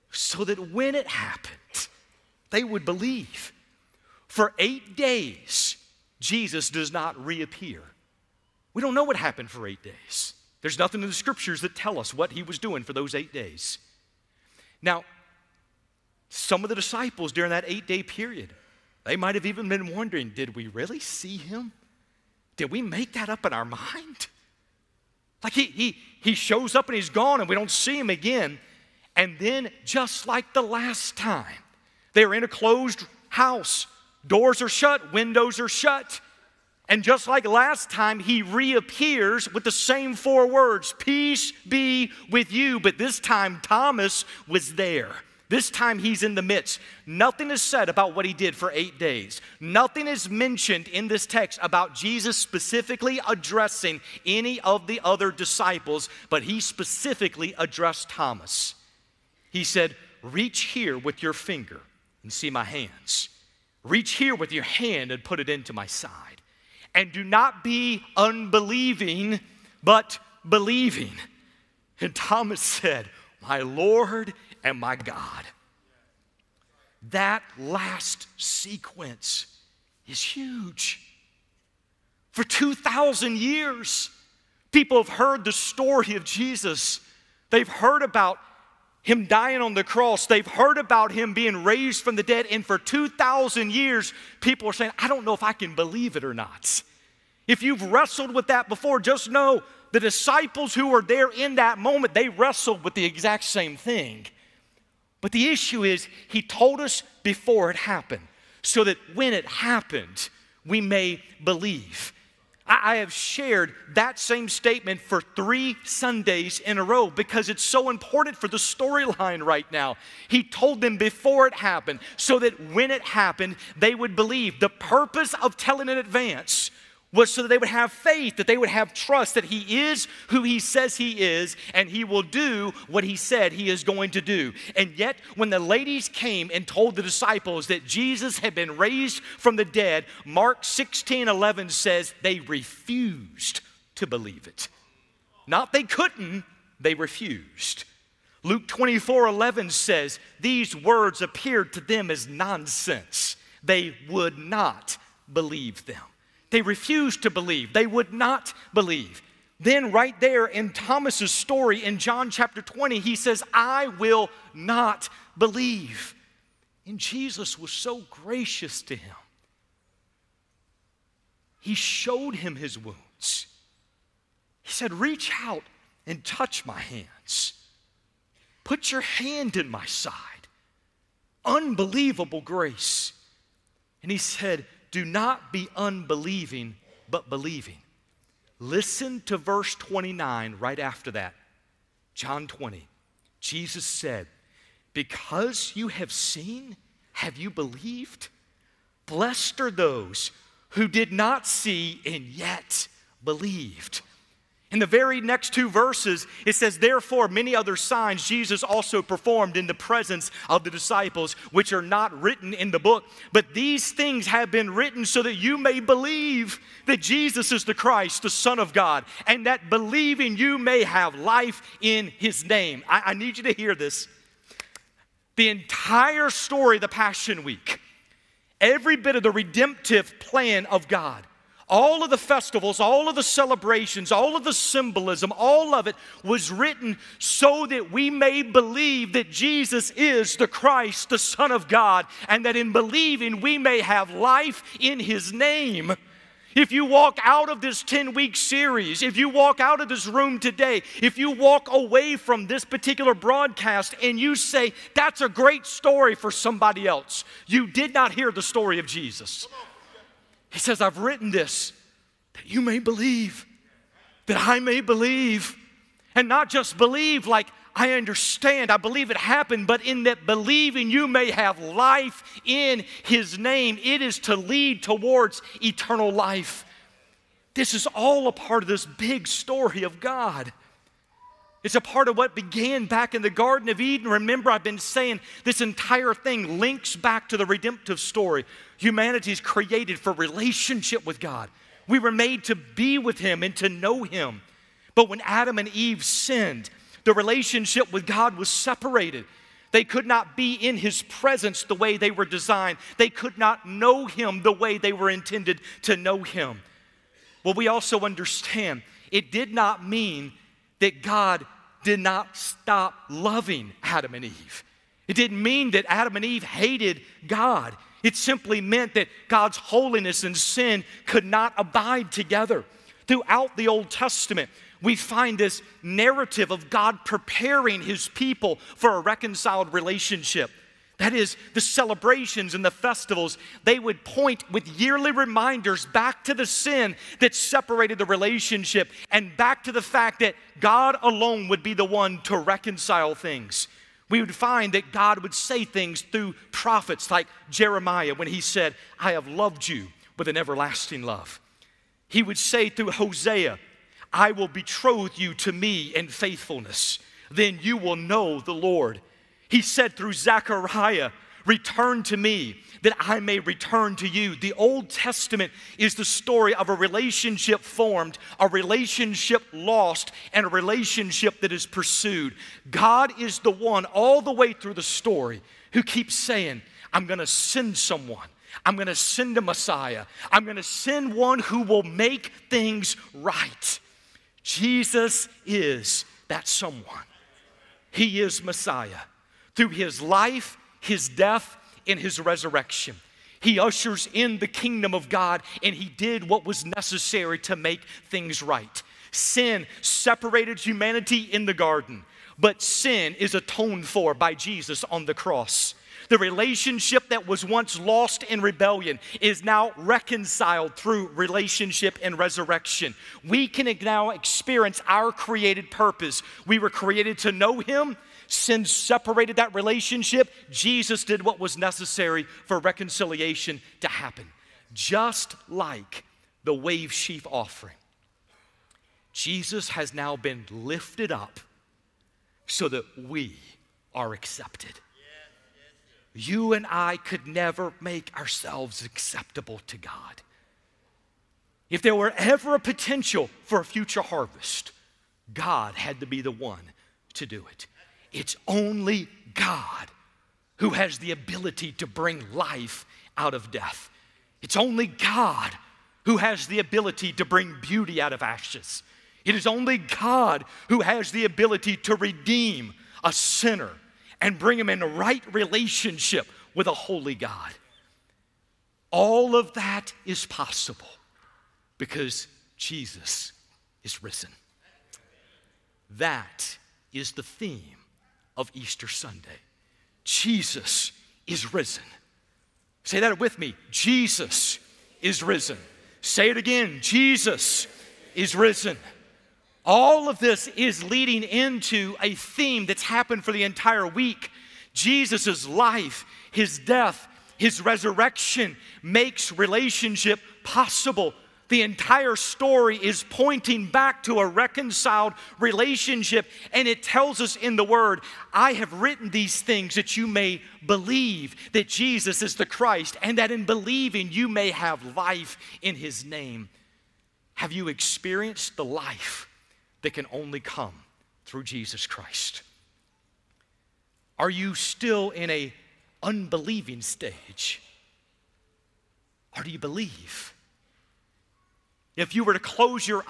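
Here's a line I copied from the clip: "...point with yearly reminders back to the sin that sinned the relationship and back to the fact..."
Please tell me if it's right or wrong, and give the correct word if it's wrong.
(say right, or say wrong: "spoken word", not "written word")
wrong: "separated", not "sinned".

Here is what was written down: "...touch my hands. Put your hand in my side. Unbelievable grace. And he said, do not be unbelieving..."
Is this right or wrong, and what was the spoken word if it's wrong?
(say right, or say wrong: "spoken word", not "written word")
right.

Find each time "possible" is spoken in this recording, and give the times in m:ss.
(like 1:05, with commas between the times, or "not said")
7:50, 8:20.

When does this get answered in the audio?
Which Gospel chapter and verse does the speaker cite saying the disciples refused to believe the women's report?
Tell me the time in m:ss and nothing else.
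2:20.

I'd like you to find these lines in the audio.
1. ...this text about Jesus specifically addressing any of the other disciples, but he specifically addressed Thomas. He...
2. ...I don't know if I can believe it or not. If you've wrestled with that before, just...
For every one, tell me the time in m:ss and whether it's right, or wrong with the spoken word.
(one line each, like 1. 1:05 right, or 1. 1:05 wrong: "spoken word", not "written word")
1. 0:51 right
2. 1:34 right.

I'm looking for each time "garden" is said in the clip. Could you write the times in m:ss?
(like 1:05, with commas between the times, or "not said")
4:43, 6:41.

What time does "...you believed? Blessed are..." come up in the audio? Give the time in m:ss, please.
3:17.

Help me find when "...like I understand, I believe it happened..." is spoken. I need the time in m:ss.
4:27.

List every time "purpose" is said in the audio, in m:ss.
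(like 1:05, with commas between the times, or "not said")
2:04, 6:55.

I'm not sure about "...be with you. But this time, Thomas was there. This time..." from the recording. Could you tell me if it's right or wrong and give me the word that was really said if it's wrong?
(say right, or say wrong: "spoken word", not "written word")
right.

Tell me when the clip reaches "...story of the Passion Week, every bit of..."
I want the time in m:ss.
3:46.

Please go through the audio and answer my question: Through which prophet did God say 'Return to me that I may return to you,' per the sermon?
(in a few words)
Zechariah.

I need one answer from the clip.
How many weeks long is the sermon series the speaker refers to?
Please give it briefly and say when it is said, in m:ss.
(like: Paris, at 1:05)
10, at 4:07.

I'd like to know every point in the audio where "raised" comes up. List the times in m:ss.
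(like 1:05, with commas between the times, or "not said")
1:31, 2:18.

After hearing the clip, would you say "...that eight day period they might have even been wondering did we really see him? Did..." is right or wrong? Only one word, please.
right.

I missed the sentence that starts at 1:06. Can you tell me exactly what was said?
And do not be unbelieving, but believing.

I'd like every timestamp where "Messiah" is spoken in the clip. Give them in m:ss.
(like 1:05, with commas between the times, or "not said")
6:19, 6:28.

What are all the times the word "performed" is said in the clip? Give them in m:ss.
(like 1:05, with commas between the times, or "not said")
3:29.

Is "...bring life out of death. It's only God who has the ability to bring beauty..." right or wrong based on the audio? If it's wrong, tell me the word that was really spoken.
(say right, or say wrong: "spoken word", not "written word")
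right.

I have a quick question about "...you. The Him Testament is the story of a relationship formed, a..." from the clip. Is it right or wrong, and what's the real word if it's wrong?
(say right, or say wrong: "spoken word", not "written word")
wrong: "Old", not "Him".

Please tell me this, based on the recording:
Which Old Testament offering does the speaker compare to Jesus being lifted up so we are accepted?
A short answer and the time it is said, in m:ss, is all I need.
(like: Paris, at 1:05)
wave sheaf offering, at 7:06.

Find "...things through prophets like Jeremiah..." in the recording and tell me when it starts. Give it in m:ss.
5:45.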